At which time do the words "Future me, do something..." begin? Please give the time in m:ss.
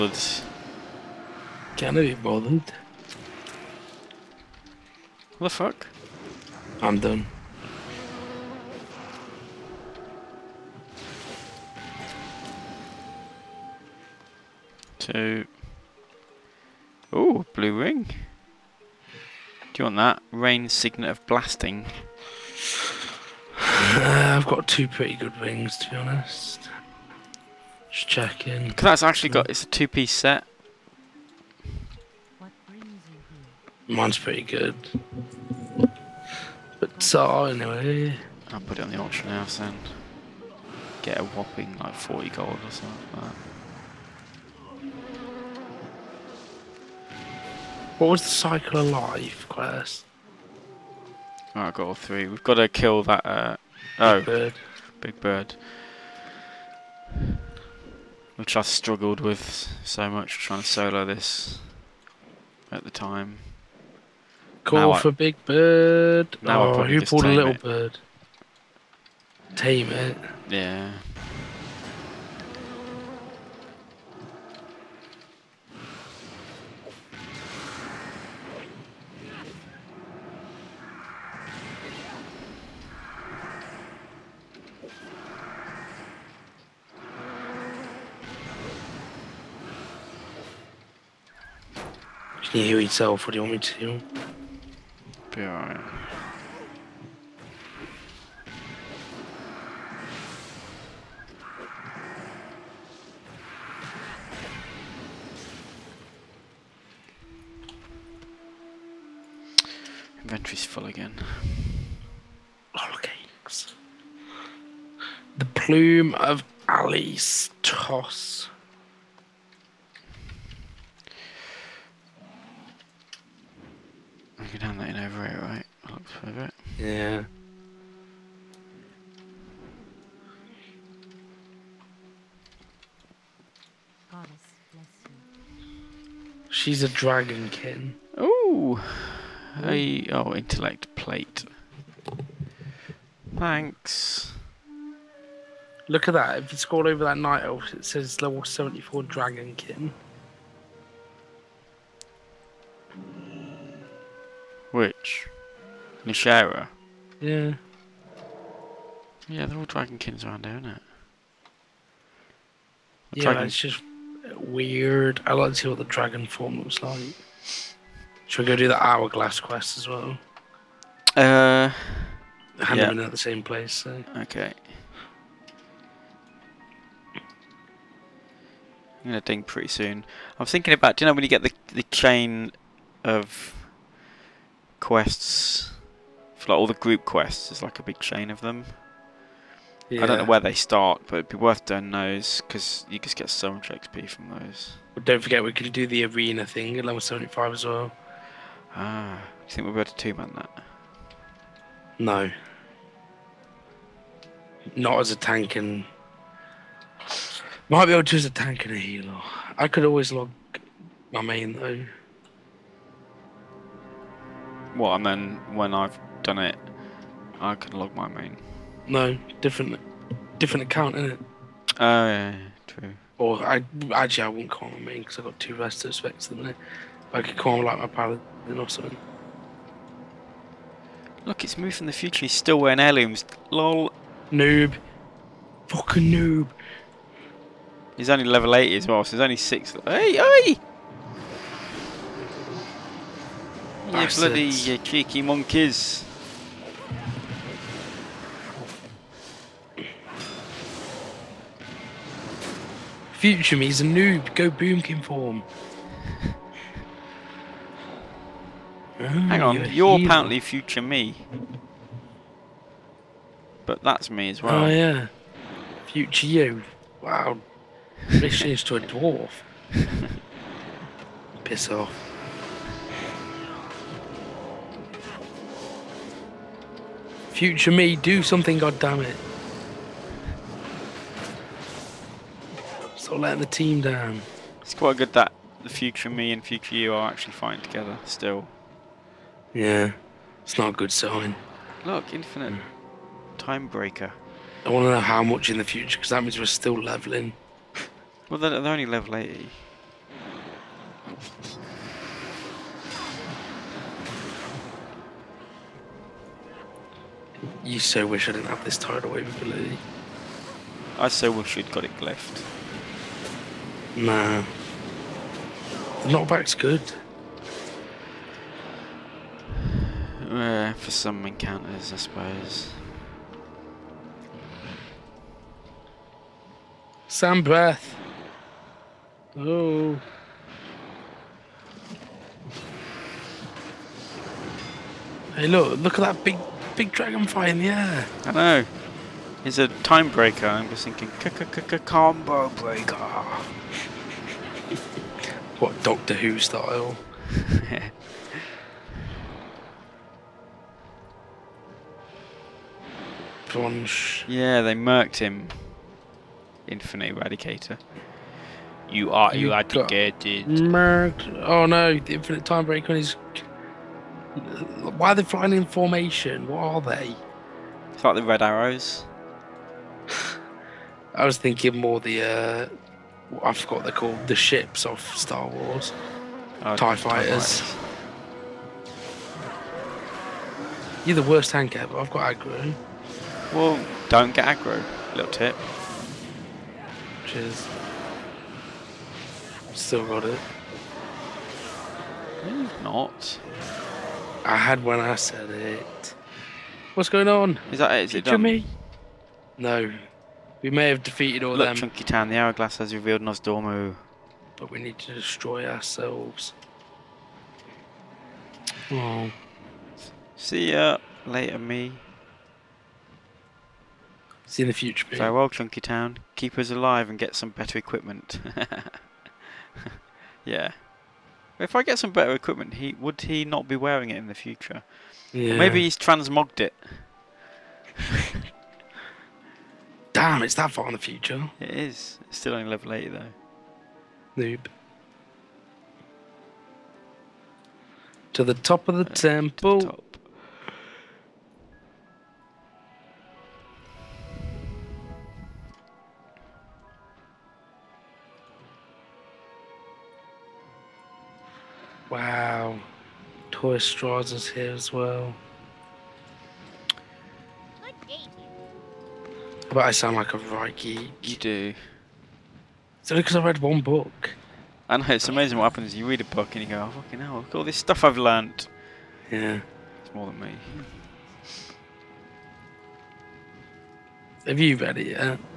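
4:37.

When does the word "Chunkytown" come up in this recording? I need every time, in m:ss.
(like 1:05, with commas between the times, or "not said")
6:41, 6:55.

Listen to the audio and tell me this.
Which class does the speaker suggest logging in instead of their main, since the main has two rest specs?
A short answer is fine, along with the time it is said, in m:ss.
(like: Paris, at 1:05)
Paladin, at 3:47.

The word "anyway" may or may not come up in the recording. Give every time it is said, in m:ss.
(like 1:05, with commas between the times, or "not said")
0:37.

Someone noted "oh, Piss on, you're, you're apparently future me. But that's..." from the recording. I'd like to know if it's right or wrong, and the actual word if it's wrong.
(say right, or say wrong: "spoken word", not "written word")
wrong: "Hang", not "Piss".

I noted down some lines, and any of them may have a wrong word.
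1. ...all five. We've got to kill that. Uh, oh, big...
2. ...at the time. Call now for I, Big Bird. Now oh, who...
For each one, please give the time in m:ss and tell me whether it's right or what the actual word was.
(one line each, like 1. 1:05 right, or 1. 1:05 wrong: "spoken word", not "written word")
1. 0:51 wrong: "three", not "five"
2. 1:02 right.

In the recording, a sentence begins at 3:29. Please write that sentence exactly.
I could always log my main though.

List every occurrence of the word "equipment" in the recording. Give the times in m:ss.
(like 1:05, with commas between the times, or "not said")
6:57, 7:02.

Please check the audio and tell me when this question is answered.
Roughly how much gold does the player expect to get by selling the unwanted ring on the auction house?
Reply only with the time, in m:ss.
0:41.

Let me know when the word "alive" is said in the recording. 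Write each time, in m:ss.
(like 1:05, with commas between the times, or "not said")
0:48, 6:56.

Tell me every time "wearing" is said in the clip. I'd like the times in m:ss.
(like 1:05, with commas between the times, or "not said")
3:52, 7:03.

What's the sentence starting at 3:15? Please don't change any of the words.
don't forget, we could do the arena thing at level 75 as well.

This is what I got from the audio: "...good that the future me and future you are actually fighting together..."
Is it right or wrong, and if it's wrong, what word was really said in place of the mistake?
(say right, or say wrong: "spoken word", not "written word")
right.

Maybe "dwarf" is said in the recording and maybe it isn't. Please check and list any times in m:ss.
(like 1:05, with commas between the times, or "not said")
4:28.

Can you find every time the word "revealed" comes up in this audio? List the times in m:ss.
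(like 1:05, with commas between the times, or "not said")
6:42.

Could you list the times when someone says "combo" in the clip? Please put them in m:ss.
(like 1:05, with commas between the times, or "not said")
5:41.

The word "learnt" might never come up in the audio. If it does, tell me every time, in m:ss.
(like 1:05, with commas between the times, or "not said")
7:48.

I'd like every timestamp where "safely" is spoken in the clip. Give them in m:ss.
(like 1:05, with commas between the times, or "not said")
not said.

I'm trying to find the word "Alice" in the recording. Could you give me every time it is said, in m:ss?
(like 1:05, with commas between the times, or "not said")
1:56.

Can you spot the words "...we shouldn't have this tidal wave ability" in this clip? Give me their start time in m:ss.
5:08.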